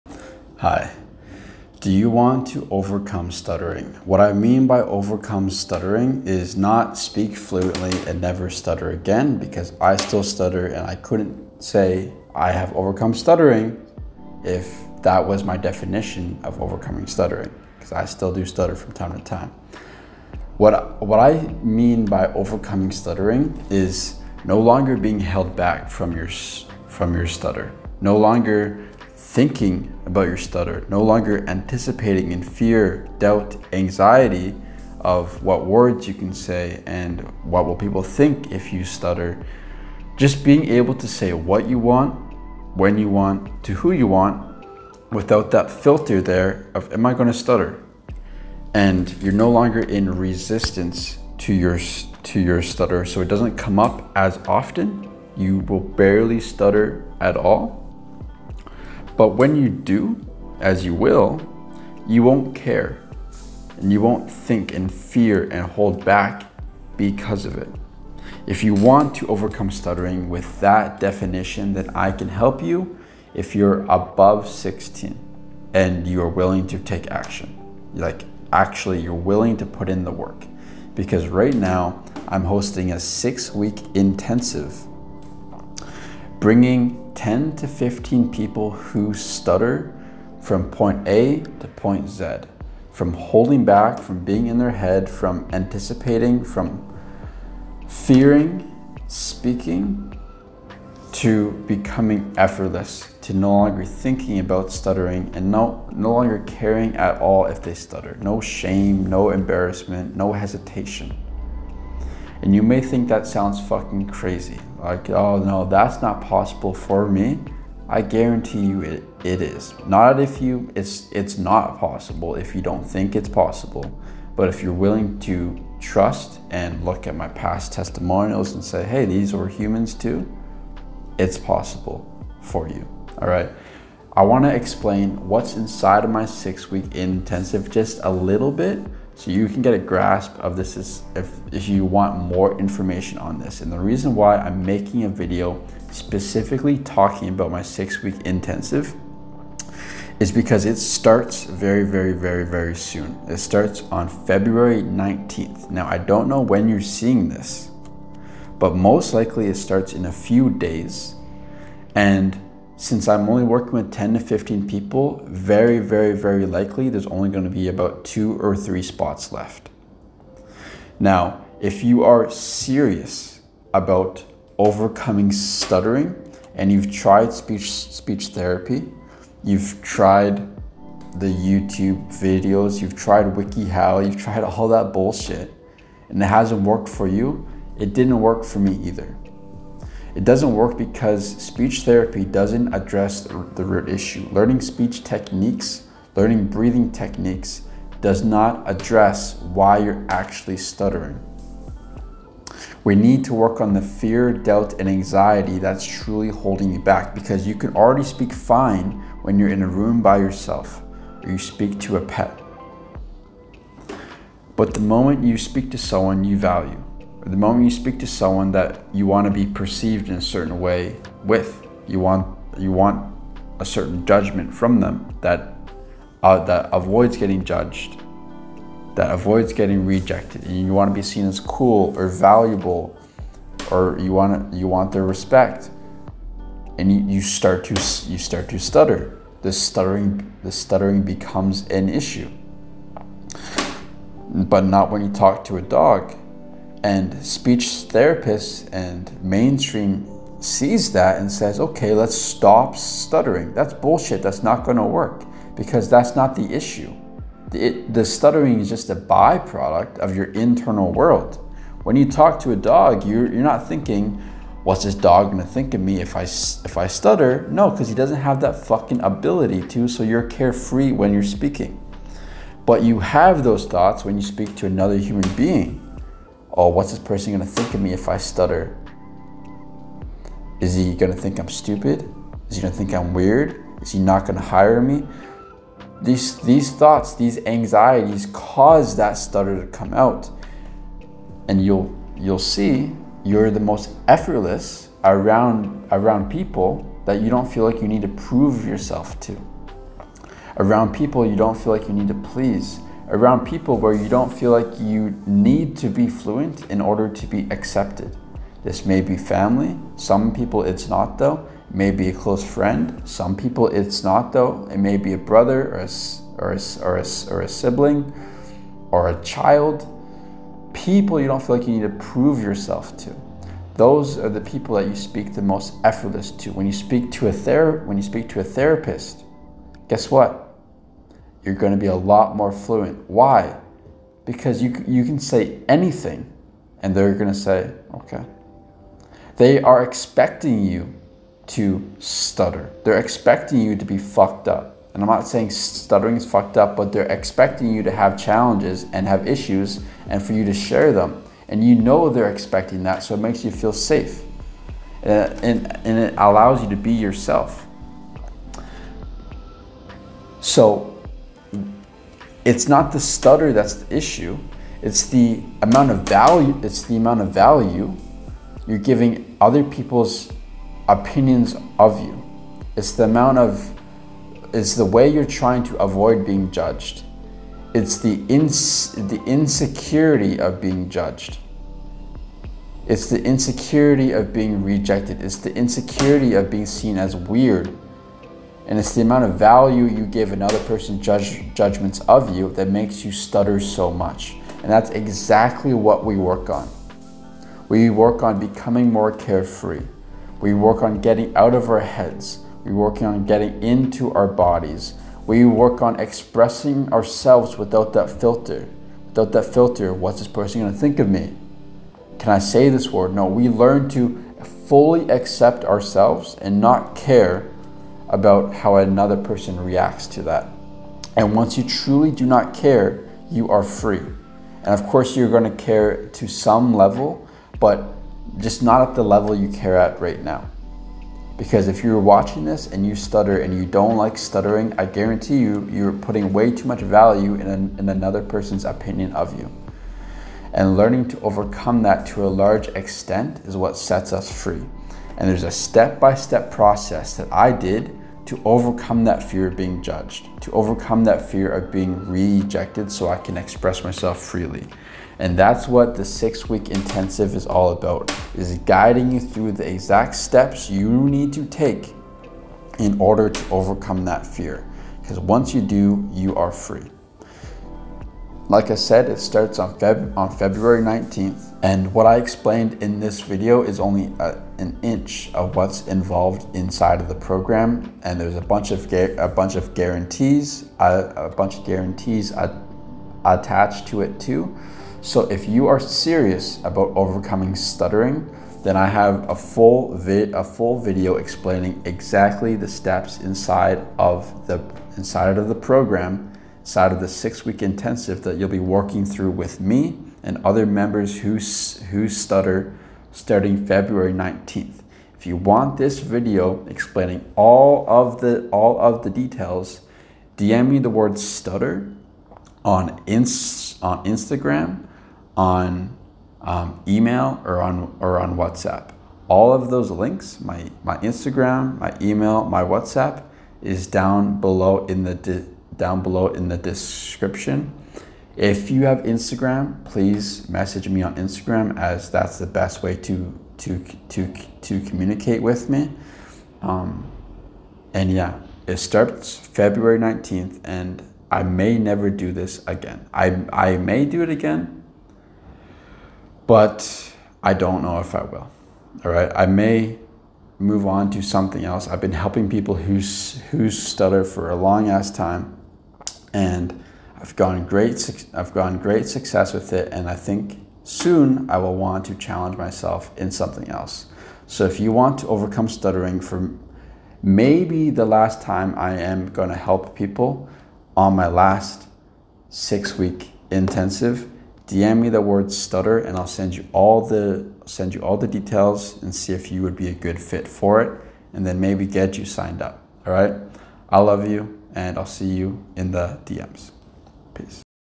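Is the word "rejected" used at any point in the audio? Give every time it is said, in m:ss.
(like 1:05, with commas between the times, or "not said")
3:49, 6:24, 7:32.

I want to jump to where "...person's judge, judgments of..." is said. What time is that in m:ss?
6:30.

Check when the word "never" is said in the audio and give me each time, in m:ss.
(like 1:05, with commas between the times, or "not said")
0:08, 9:01.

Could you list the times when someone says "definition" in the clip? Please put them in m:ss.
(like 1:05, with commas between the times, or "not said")
0:15, 1:10.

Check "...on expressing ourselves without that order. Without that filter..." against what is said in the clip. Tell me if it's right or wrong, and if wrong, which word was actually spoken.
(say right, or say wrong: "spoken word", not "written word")
wrong: "filter", not "order".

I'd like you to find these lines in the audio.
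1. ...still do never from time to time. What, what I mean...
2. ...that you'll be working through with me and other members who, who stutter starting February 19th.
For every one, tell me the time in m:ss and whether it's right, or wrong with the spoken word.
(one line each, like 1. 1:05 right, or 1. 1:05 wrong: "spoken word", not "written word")
1. 0:18 wrong: "stutter", not "never"
2. 8:18 right.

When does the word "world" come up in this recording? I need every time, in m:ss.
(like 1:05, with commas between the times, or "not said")
4:20.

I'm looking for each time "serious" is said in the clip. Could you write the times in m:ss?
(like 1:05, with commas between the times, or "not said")
2:52, 8:05.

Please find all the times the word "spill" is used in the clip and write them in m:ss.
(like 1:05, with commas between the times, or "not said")
not said.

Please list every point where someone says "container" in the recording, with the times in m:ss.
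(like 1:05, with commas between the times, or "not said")
not said.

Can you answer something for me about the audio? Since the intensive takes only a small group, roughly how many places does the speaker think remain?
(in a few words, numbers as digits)
2 or 3.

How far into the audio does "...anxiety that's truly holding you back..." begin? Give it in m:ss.
3:24.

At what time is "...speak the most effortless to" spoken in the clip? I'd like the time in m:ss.
5:24.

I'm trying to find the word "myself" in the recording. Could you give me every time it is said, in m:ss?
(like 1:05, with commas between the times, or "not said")
7:33, 9:22.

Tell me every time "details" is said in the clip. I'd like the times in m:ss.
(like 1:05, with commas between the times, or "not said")
8:29, 9:38.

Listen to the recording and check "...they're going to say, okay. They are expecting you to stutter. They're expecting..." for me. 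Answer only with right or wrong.
right.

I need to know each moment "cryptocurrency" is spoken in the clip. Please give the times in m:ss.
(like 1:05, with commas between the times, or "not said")
not said.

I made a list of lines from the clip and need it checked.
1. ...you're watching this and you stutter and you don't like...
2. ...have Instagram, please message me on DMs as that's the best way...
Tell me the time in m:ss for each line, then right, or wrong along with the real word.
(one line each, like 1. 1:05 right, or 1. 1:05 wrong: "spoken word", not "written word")
1. 7:11 right
2. 8:48 wrong: "Instagram", not "DMs".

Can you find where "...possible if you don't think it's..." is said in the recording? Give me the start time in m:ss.
2:01.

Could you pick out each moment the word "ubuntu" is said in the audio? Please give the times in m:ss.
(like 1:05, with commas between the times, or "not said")
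not said.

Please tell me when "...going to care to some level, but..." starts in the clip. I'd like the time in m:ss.
7:05.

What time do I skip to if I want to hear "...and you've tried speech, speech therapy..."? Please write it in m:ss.
2:56.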